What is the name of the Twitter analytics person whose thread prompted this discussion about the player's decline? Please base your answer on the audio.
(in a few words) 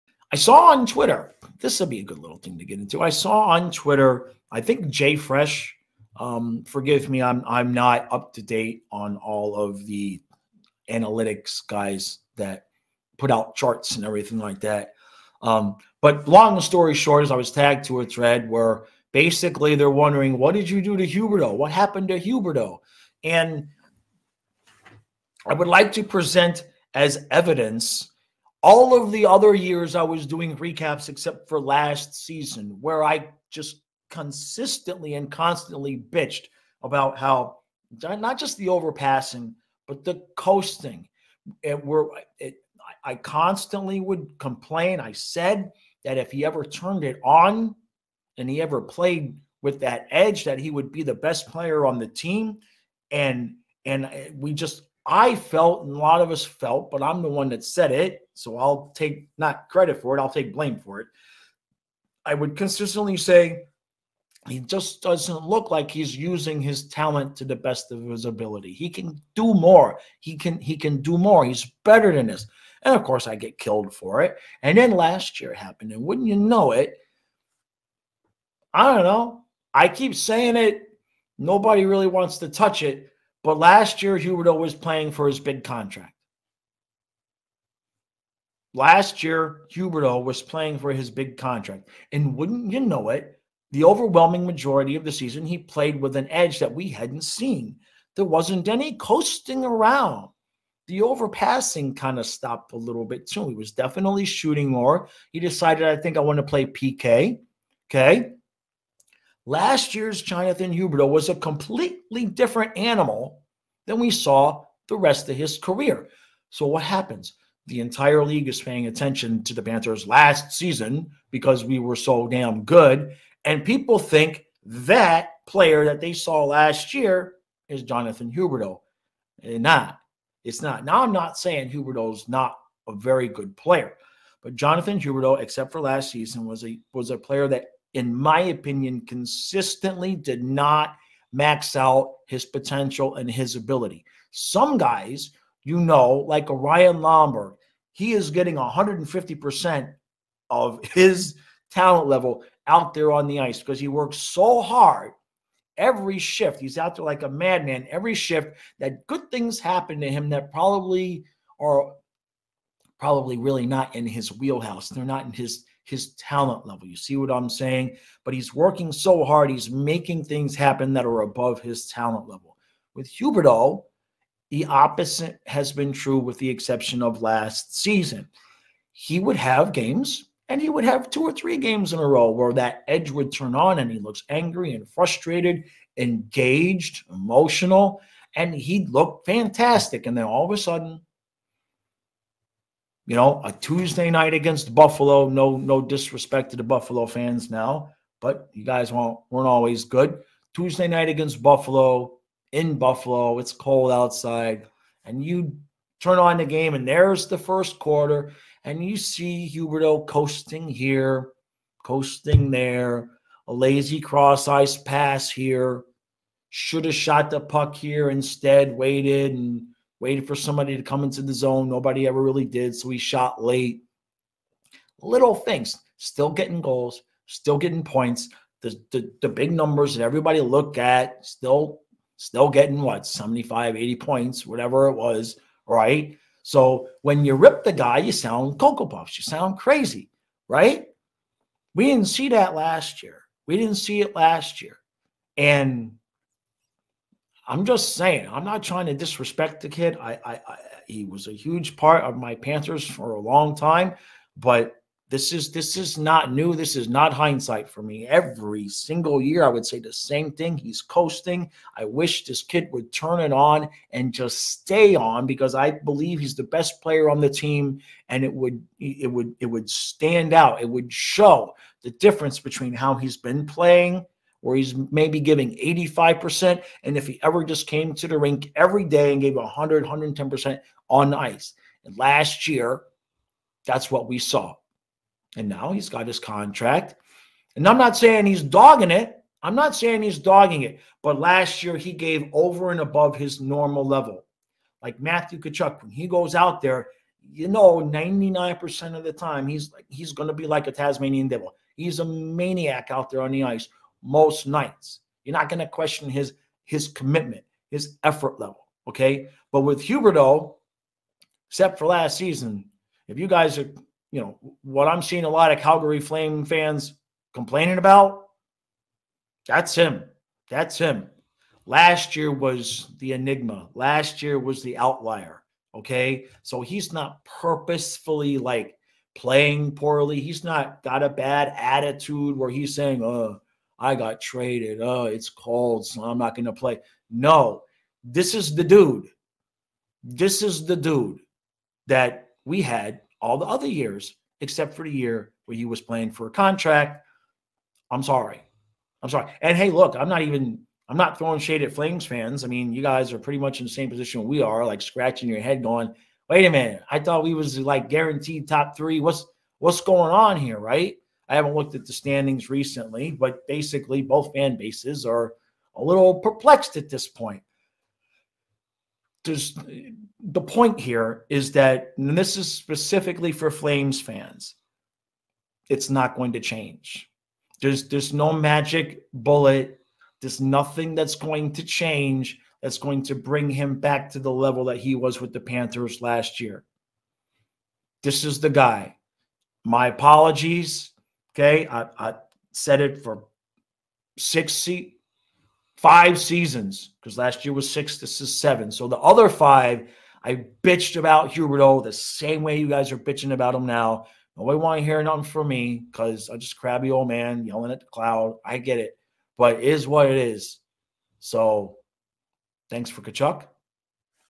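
Jay Fresh.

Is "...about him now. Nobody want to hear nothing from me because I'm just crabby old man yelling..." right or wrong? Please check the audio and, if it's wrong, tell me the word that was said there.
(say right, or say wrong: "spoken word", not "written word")
right.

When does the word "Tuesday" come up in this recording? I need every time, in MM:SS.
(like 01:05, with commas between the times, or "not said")
03:13, 03:20.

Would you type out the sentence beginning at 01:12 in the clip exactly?
And of course I get killed for it.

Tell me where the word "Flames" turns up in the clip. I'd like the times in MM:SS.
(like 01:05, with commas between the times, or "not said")
05:15, 05:51, 06:13.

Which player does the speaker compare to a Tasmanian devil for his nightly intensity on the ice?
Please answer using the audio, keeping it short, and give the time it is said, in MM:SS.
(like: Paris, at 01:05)
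Matthew Tkachuk, at 04:54.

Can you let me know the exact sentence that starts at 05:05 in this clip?
You're not going to question his his commitment, his effort level.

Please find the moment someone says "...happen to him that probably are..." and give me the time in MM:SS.
02:39.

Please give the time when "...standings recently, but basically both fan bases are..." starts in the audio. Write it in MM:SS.
06:01.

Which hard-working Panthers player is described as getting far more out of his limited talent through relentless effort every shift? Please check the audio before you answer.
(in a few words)
Ryan Lomberg.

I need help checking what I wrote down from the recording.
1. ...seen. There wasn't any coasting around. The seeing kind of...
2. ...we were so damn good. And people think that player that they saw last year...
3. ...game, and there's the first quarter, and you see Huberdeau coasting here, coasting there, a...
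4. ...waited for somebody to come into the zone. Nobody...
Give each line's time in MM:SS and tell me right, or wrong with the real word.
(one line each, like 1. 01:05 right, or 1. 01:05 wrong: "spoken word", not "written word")
1. 01:37 wrong: "overpassing", not "seeing"
2. 02:01 right
3. 03:26 right
4. 03:40 right.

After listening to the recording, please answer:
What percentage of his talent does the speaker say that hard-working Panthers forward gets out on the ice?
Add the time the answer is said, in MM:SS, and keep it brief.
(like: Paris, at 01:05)
150%, at 02:28.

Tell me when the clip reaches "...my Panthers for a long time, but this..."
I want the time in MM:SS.
04:12.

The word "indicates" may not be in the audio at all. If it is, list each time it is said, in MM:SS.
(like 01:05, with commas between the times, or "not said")
not said.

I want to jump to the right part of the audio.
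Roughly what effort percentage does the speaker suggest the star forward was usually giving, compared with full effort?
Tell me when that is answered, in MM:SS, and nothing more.
04:35.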